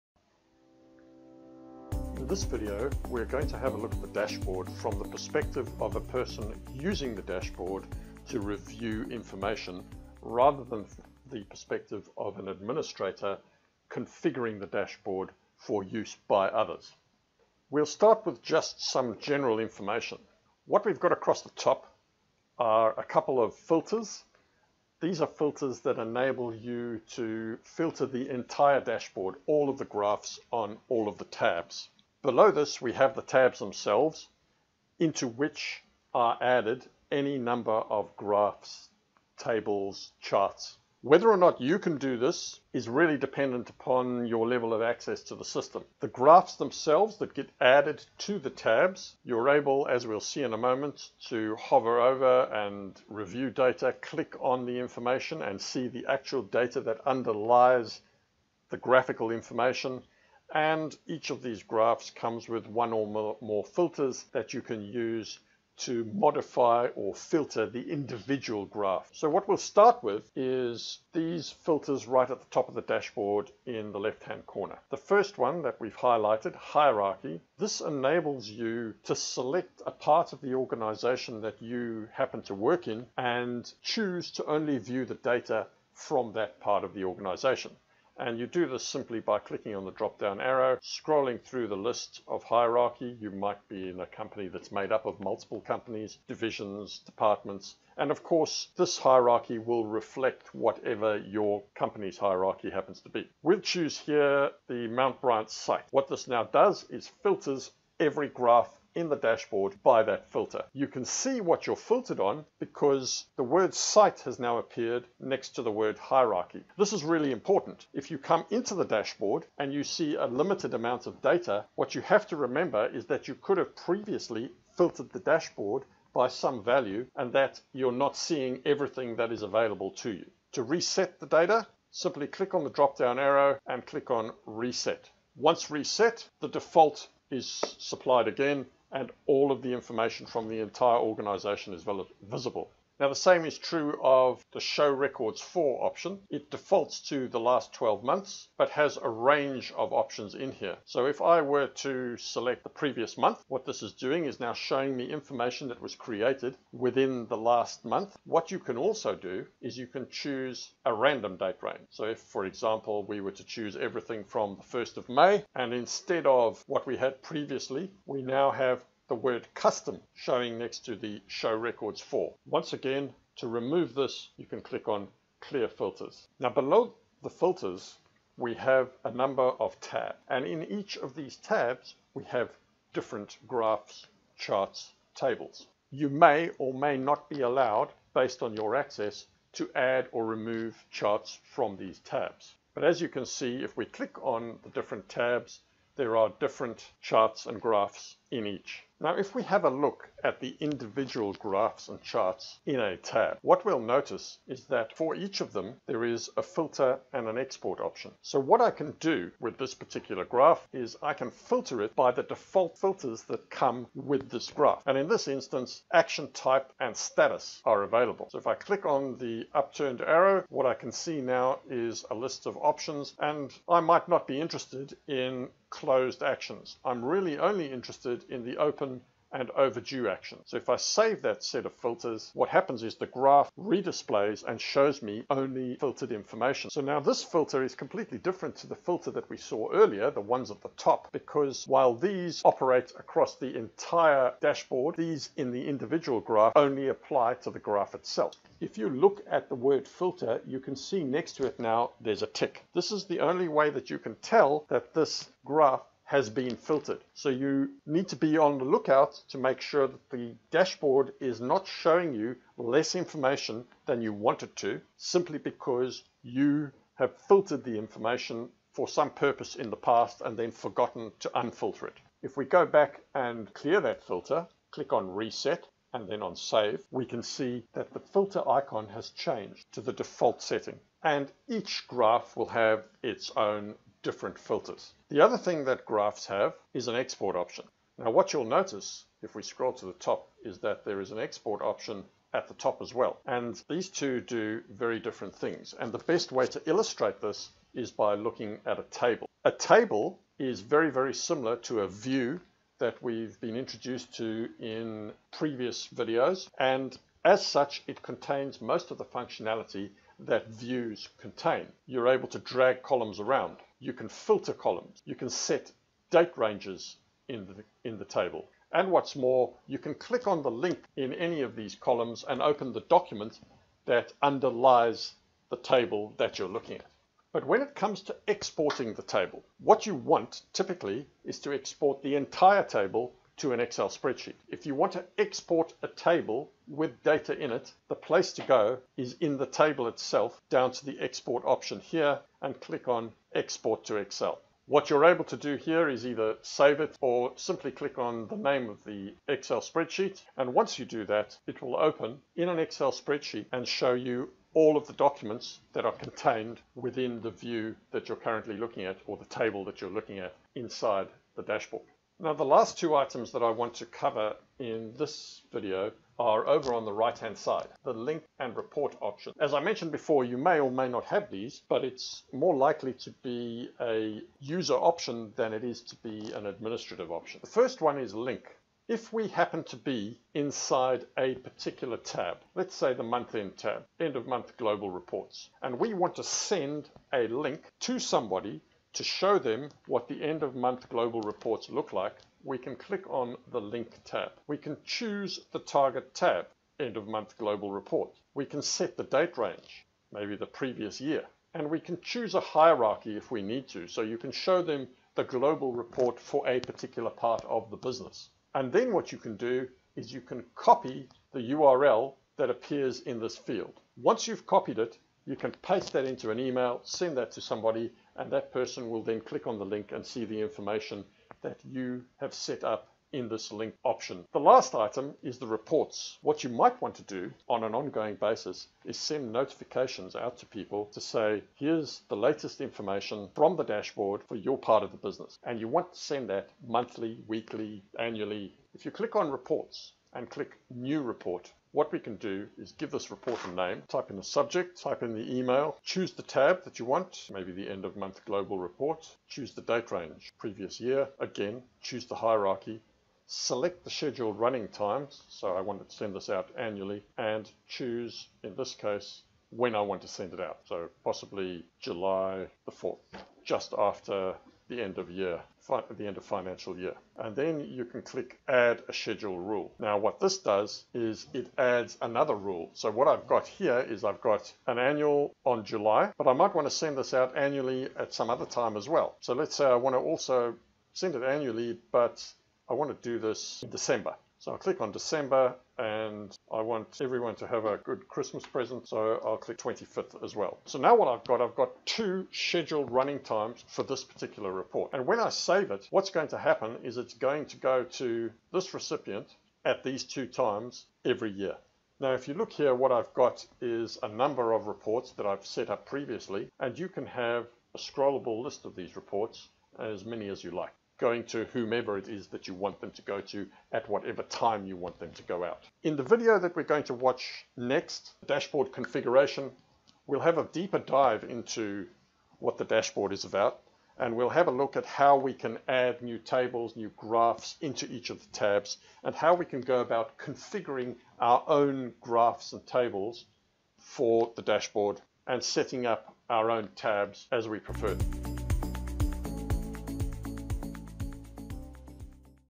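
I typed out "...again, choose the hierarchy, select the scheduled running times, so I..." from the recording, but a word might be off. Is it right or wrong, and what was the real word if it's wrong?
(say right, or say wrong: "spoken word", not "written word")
right.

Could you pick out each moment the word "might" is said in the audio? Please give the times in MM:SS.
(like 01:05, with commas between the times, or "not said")
01:33, 03:43, 07:06, 07:56.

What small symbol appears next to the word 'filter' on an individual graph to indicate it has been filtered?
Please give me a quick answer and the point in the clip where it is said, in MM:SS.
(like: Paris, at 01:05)
tick, at 04:12.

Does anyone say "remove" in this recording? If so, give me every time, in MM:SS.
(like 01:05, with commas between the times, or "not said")
02:53, 03:10.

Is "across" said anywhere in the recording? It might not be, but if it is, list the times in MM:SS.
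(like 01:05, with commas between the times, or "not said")
00:21, 04:02.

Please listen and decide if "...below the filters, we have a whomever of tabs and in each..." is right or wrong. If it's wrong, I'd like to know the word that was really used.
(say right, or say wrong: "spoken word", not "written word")
wrong: "number", not "whomever".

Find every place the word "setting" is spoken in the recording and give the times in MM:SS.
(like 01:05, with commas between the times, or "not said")
04:40, 08:55.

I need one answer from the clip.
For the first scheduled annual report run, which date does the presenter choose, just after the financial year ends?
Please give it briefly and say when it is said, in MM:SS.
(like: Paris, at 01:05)
July 4, at 07:41.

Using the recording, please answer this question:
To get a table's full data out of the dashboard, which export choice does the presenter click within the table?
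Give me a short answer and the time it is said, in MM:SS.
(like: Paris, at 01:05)
export to Excel, at 05:43.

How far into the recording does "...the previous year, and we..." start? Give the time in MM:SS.
06:40.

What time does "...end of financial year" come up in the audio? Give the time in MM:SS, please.
07:46.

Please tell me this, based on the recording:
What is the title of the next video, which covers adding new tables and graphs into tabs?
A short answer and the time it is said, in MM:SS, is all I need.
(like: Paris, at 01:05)
dashboard configuration, at 08:38.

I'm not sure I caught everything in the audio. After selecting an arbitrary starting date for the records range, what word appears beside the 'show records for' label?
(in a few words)
custom.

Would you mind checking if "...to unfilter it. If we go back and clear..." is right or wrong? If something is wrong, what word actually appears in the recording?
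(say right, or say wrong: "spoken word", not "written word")
right.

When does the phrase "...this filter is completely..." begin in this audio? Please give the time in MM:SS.
03:56.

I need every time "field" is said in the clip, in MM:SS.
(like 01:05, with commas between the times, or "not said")
06:53.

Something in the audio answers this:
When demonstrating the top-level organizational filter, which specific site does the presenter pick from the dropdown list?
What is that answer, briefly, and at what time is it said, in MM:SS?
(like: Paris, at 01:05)
Mount Bryant, at 01:44.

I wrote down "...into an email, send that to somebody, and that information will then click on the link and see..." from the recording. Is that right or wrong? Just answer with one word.
wrong.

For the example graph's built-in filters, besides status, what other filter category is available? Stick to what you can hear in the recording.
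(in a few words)
action type.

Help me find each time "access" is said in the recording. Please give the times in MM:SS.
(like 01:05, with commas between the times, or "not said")
00:44, 03:08.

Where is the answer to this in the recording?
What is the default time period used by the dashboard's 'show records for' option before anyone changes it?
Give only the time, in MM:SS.
02:27.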